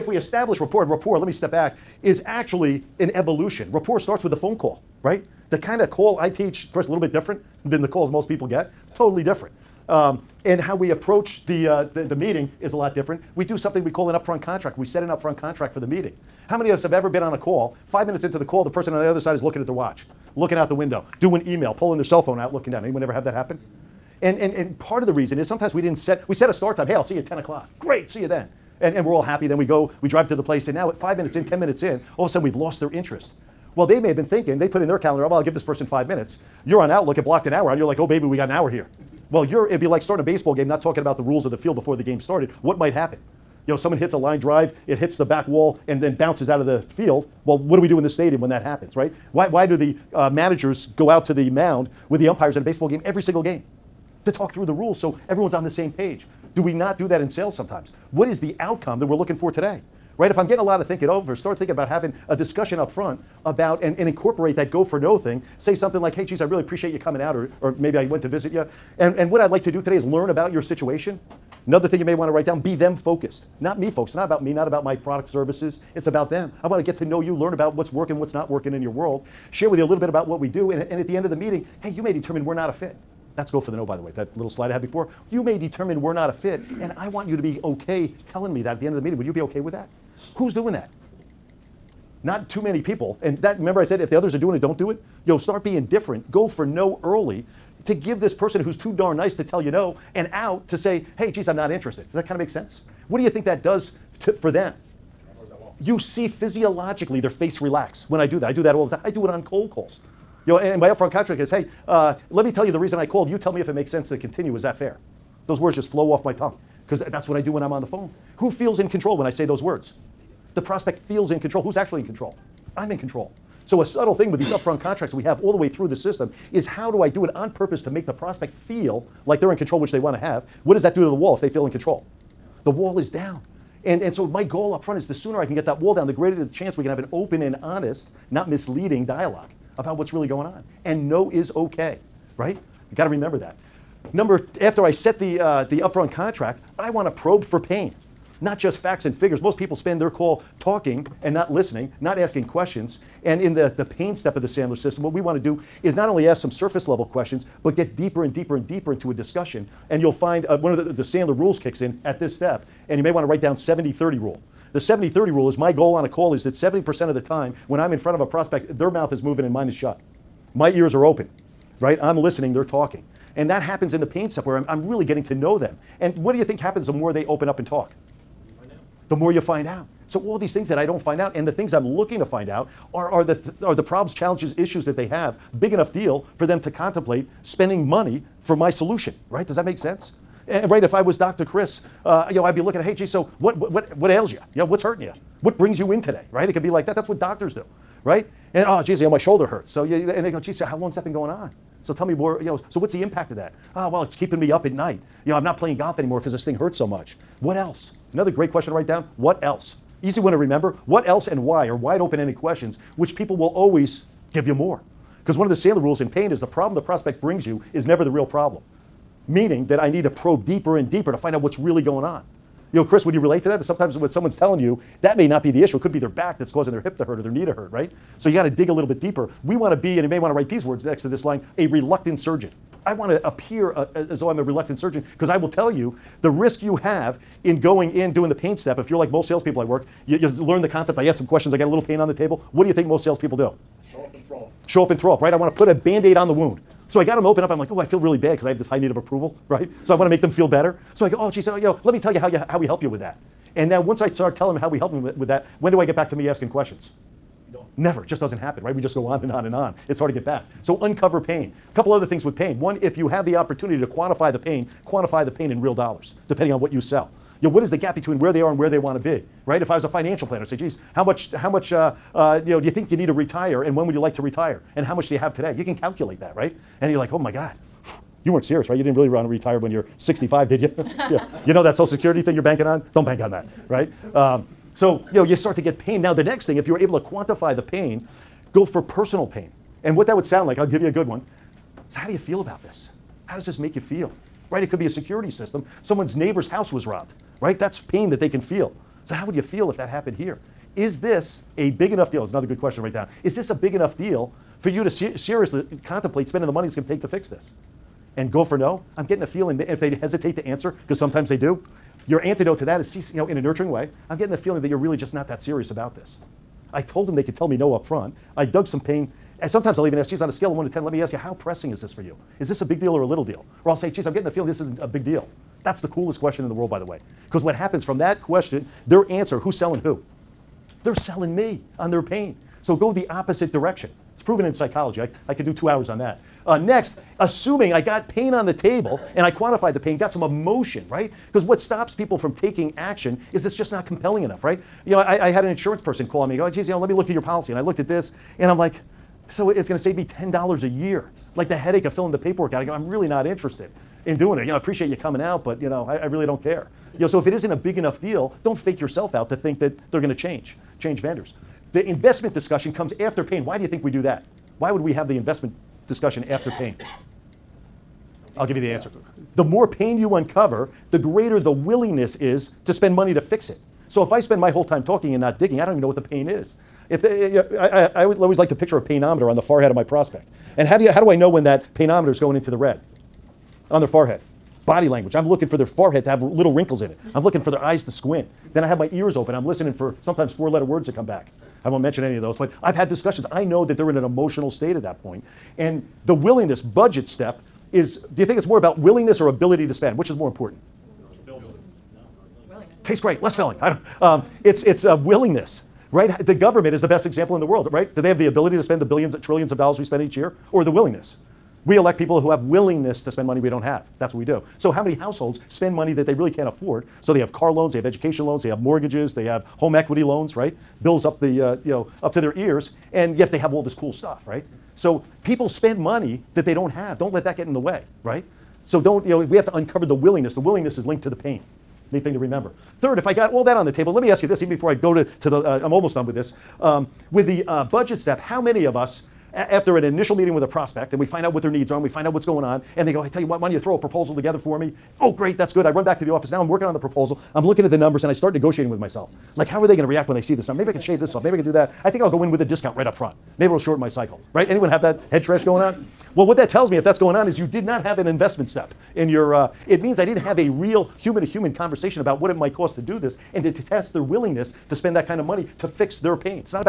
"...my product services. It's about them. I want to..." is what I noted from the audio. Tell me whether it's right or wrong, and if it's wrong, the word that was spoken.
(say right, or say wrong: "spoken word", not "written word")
right.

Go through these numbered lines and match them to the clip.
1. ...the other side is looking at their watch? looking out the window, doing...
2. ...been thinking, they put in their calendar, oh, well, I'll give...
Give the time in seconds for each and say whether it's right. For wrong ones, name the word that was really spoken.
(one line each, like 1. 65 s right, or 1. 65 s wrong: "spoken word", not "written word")
1. 19 s right
2. 34 s right.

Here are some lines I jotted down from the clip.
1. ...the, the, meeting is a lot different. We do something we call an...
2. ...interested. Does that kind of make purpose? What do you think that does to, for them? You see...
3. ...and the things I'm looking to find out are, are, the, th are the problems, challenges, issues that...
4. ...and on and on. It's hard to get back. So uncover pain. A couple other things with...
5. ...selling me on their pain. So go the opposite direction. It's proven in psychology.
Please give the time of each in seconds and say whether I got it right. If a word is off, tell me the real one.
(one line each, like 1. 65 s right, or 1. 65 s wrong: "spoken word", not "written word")
1. 11 s right
2. 101 s wrong: "sense", not "purpose"
3. 181 s right
4. 259 s right
5. 330 s right.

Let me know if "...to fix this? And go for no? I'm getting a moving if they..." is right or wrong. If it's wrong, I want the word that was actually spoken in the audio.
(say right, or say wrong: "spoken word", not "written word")
wrong: "feeling", not "moving".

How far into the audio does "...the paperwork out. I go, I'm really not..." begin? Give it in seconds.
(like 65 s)
352 s.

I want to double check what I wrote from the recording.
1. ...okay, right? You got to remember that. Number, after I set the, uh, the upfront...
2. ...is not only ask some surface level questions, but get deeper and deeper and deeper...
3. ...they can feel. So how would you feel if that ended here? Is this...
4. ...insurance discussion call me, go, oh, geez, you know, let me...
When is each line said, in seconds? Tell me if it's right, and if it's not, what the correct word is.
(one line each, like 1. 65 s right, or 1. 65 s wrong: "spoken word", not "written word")
1. 141 s right
2. 155 s right
3. 298 s wrong: "happened", not "ended"
4. 345 s wrong: "person", not "discussion".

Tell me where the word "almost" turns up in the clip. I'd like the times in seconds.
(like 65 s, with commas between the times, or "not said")
435 s.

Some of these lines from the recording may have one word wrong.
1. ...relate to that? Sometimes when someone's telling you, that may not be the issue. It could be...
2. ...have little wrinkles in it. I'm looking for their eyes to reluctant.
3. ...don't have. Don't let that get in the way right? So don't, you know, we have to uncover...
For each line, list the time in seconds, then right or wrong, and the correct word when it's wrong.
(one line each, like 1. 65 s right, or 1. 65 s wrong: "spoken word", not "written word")
1. 223 s right
2. 386 s wrong: "squint", not "reluctant"
3. 426 s right.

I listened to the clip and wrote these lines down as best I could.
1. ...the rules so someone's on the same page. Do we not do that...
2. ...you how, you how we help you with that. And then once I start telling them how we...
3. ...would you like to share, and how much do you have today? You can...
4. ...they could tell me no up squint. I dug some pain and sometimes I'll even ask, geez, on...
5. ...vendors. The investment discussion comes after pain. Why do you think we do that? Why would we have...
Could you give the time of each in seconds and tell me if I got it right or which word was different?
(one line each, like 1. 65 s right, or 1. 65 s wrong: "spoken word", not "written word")
1. 54 s wrong: "everyone", not "someone"
2. 252 s right
3. 273 s wrong: "retire", not "share"
4. 317 s wrong: "front", not "squint"
5. 360 s right.